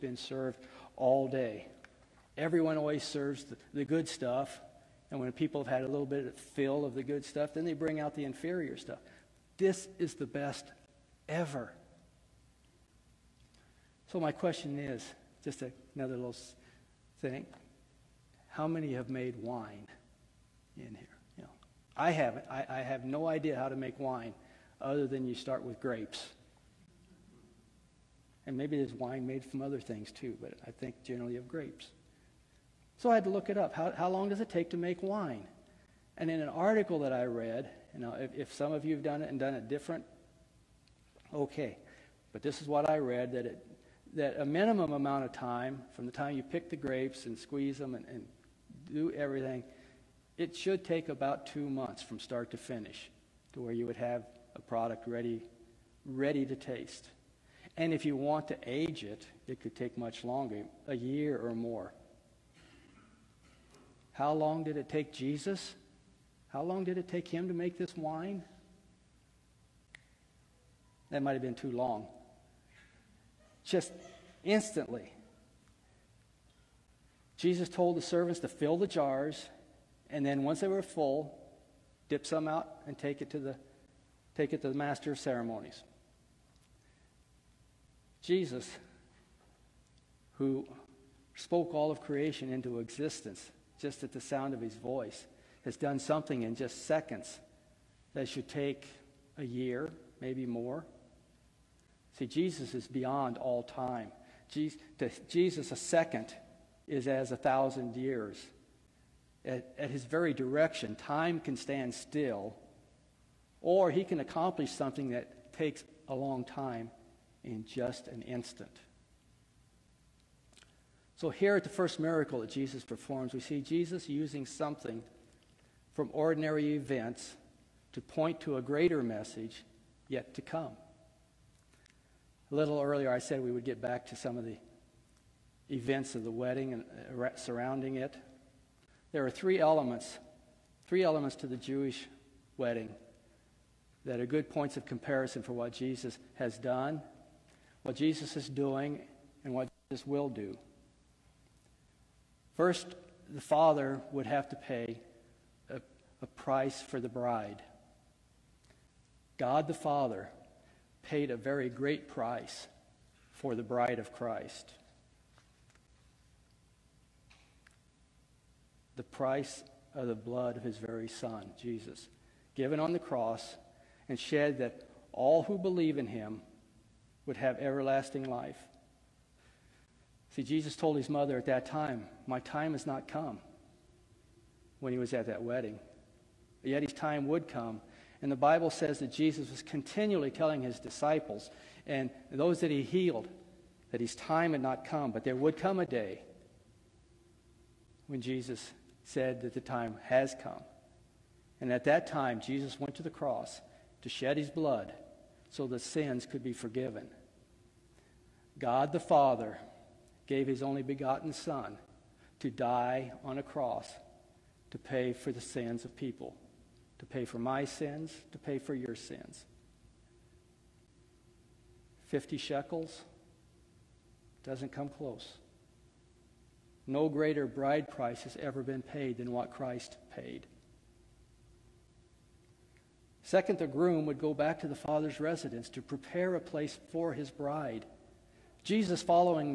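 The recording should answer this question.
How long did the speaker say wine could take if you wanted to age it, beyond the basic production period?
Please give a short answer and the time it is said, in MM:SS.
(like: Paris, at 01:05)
a year or more, at 01:00.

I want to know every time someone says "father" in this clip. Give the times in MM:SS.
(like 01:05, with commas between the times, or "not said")
02:33, 02:39, 03:28, 03:54.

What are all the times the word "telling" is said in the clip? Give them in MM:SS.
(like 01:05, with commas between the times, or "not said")
03:10.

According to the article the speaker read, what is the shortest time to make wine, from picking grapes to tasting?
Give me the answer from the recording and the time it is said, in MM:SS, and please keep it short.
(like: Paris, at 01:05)
2 months, at 00:51.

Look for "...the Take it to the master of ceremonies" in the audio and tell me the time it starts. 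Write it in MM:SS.
01:23.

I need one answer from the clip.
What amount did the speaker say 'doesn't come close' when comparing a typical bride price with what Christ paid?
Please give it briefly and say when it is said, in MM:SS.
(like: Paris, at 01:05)
50 shekels, at 03:42.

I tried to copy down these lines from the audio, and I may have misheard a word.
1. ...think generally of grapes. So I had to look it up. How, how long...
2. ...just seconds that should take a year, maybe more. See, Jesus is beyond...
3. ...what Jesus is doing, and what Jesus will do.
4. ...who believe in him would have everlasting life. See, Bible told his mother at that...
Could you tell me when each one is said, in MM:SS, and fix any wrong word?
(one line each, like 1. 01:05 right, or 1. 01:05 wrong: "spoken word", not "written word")
1. 00:30 right
2. 01:36 right
3. 02:27 right
4. 02:55 wrong: "Jesus", not "Bible".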